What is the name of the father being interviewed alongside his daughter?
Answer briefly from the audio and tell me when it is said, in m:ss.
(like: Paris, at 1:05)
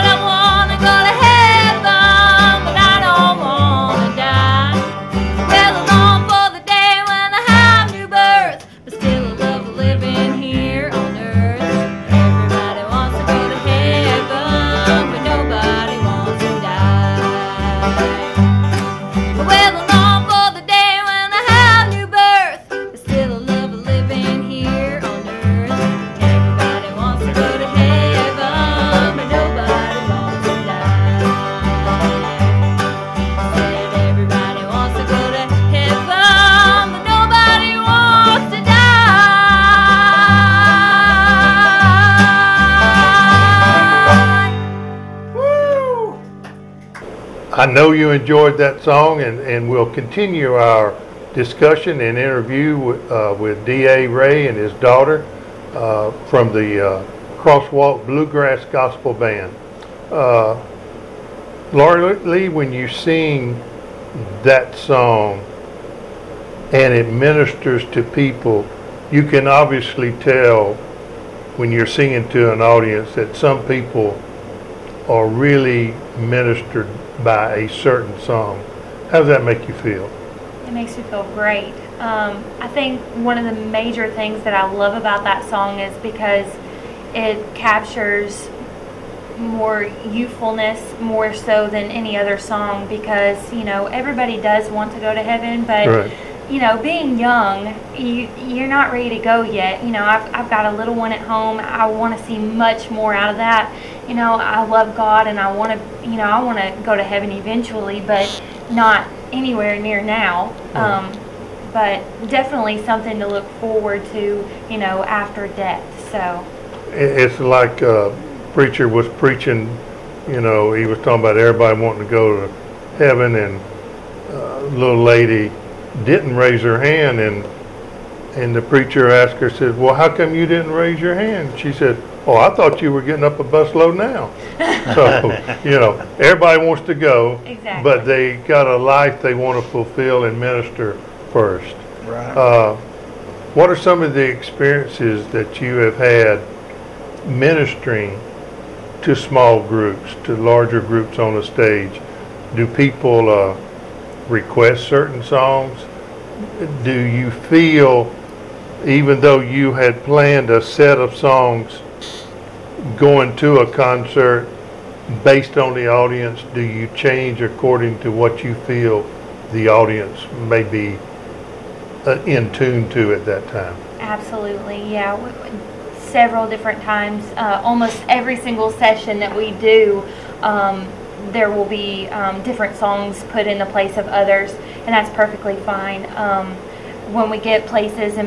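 D.A. Ray, at 0:53.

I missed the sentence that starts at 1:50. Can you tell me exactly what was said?
Um, but definitely something to look forward to, you know, after death.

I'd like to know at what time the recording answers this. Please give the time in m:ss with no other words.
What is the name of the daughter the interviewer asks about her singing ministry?
1:01.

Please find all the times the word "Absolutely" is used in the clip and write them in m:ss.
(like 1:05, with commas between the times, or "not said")
2:53.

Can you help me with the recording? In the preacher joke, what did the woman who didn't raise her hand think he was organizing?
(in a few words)
A busload.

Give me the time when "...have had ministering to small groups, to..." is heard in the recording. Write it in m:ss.
2:25.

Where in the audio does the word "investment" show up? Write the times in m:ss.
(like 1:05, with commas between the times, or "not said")
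not said.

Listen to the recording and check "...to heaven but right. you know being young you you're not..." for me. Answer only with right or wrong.
right.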